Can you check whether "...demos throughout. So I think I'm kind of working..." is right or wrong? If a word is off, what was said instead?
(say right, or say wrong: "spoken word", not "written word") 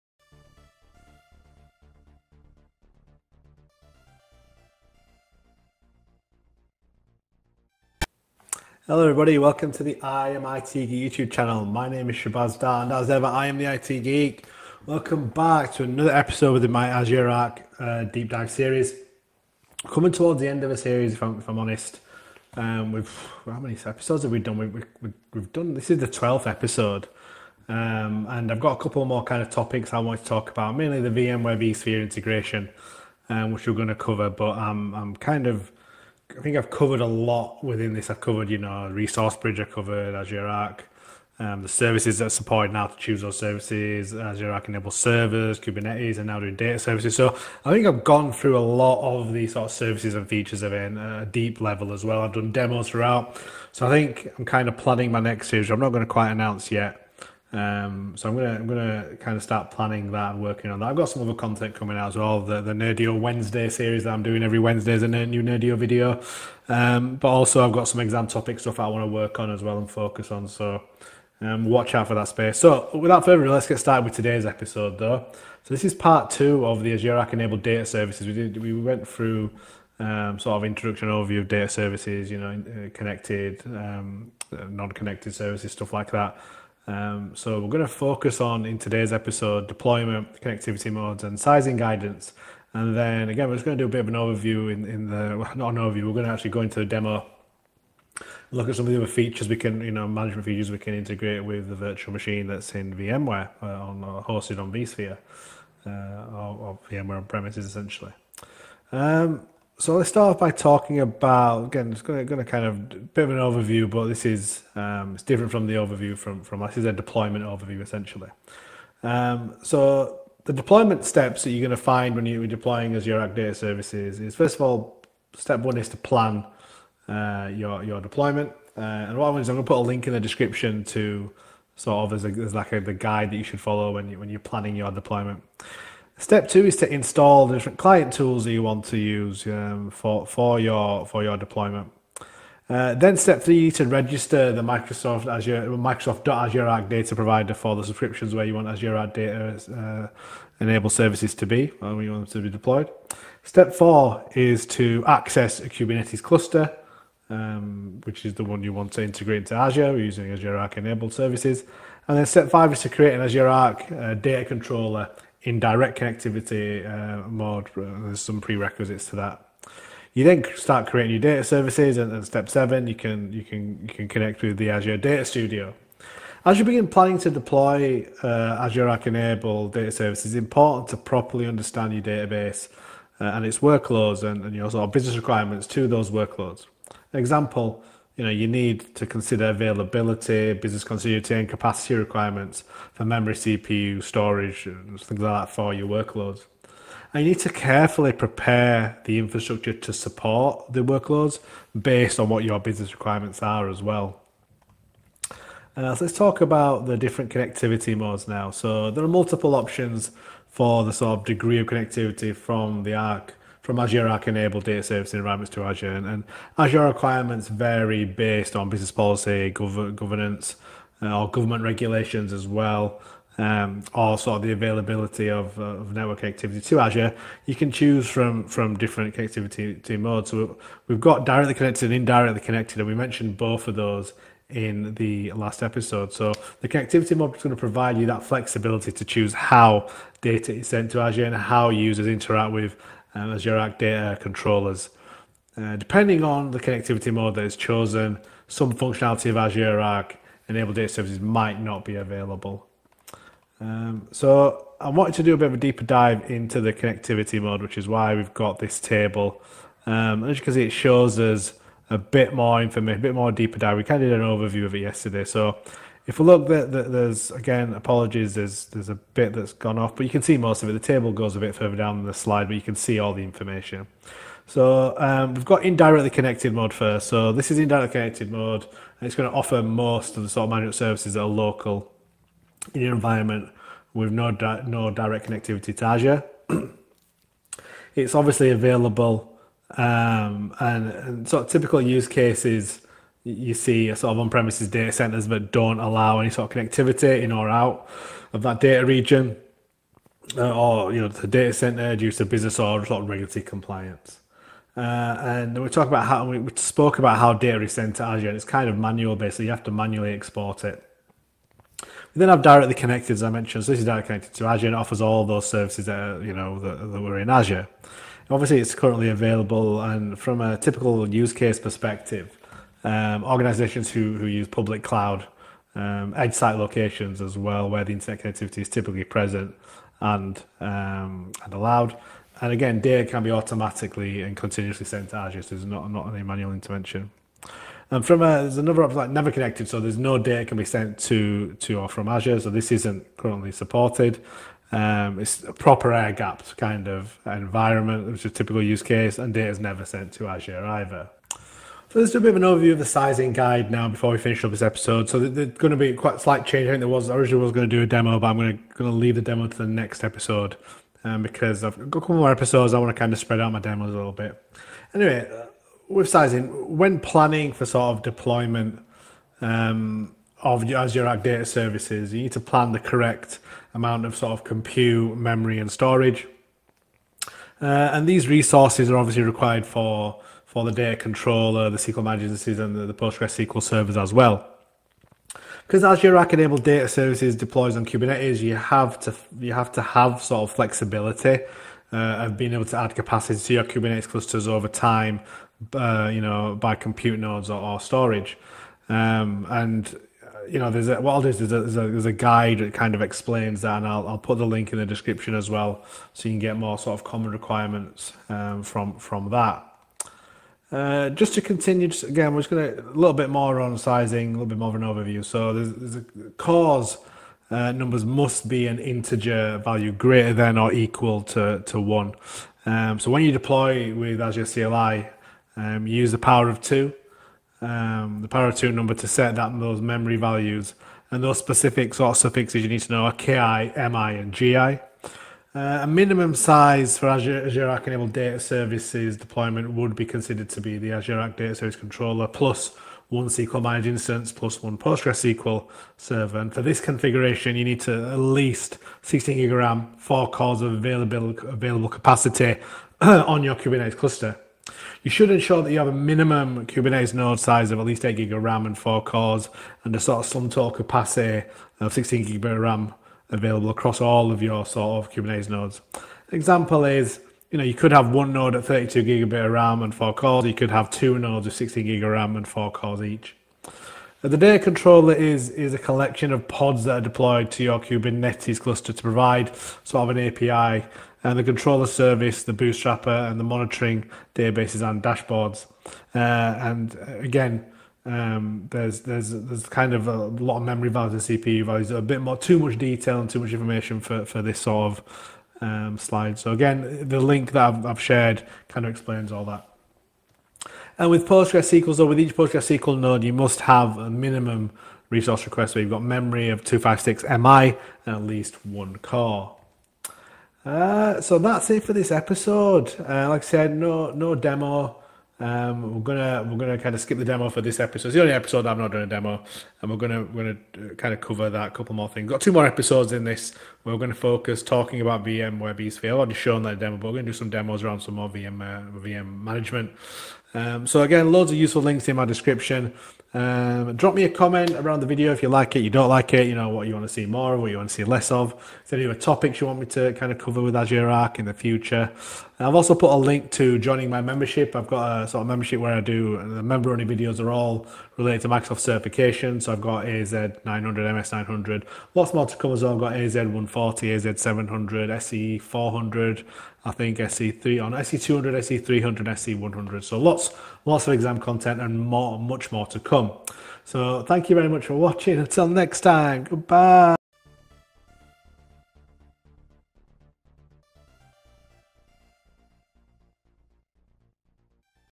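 wrong: "planning", not "working".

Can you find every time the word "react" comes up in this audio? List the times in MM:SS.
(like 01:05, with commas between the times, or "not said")
not said.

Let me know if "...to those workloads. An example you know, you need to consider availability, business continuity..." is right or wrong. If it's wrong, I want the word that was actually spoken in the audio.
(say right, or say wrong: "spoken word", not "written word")
right.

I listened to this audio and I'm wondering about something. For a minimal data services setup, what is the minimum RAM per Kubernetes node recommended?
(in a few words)
8 GB.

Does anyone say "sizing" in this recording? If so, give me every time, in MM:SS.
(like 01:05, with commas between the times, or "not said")
01:31, 05:52, 06:06, 06:53.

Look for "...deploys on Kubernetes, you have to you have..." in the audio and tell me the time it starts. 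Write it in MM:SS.
06:27.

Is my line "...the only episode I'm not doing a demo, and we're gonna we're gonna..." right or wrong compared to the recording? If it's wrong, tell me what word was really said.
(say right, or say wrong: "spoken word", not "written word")
right.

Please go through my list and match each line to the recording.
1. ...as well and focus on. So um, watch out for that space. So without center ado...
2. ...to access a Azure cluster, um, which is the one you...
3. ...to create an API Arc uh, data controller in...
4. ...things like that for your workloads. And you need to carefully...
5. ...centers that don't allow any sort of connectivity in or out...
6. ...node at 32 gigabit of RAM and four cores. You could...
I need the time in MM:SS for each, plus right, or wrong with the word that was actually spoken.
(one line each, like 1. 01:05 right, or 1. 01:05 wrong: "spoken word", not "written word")
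1. 01:09 wrong: "further", not "center"
2. 02:34 wrong: "Kubernetes", not "Azure"
3. 02:42 wrong: "Azure", not "API"
4. 03:14 right
5. 04:54 right
6. 07:48 right.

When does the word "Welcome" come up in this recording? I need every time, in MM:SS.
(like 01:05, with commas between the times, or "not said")
00:09, 00:14.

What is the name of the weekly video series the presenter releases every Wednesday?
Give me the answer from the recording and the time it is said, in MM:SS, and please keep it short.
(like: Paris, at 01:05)
Nerdio Wednesday, at 01:02.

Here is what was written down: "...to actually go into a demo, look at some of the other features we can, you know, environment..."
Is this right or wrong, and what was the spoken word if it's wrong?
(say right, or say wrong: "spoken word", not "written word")
wrong: "management", not "environment".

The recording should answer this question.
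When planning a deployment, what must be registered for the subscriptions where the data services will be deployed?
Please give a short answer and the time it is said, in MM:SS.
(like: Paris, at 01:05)
Microsoft Azure Arc data provider, at 02:25.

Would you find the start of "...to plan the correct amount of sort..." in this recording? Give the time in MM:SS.
06:12.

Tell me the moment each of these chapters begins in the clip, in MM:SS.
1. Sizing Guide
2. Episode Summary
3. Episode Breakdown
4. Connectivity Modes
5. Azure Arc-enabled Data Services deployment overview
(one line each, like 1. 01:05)
1. 05:51
2. 08:33
3. 01:15
4. 03:25
5. 01:49.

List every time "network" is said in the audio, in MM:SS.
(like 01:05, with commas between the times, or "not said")
03:45.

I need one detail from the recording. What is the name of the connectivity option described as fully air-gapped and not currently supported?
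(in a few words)
Never connected.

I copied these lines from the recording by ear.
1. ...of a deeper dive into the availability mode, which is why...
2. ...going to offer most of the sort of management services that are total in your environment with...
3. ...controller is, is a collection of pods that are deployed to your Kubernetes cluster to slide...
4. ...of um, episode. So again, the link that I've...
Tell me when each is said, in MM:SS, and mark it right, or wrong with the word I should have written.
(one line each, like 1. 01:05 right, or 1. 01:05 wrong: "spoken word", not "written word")
1. 04:15 wrong: "connectivity", not "availability"
2. 04:39 wrong: "local", not "total"
3. 07:54 wrong: "provide", not "slide"
4. 08:14 wrong: "slide", not "episode".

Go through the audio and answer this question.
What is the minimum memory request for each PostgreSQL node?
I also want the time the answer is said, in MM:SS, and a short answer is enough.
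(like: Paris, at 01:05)
256 Mi, at 08:26.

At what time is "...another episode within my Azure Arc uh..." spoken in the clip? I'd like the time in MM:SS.
00:15.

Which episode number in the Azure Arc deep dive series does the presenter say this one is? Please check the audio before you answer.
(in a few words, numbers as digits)
12th.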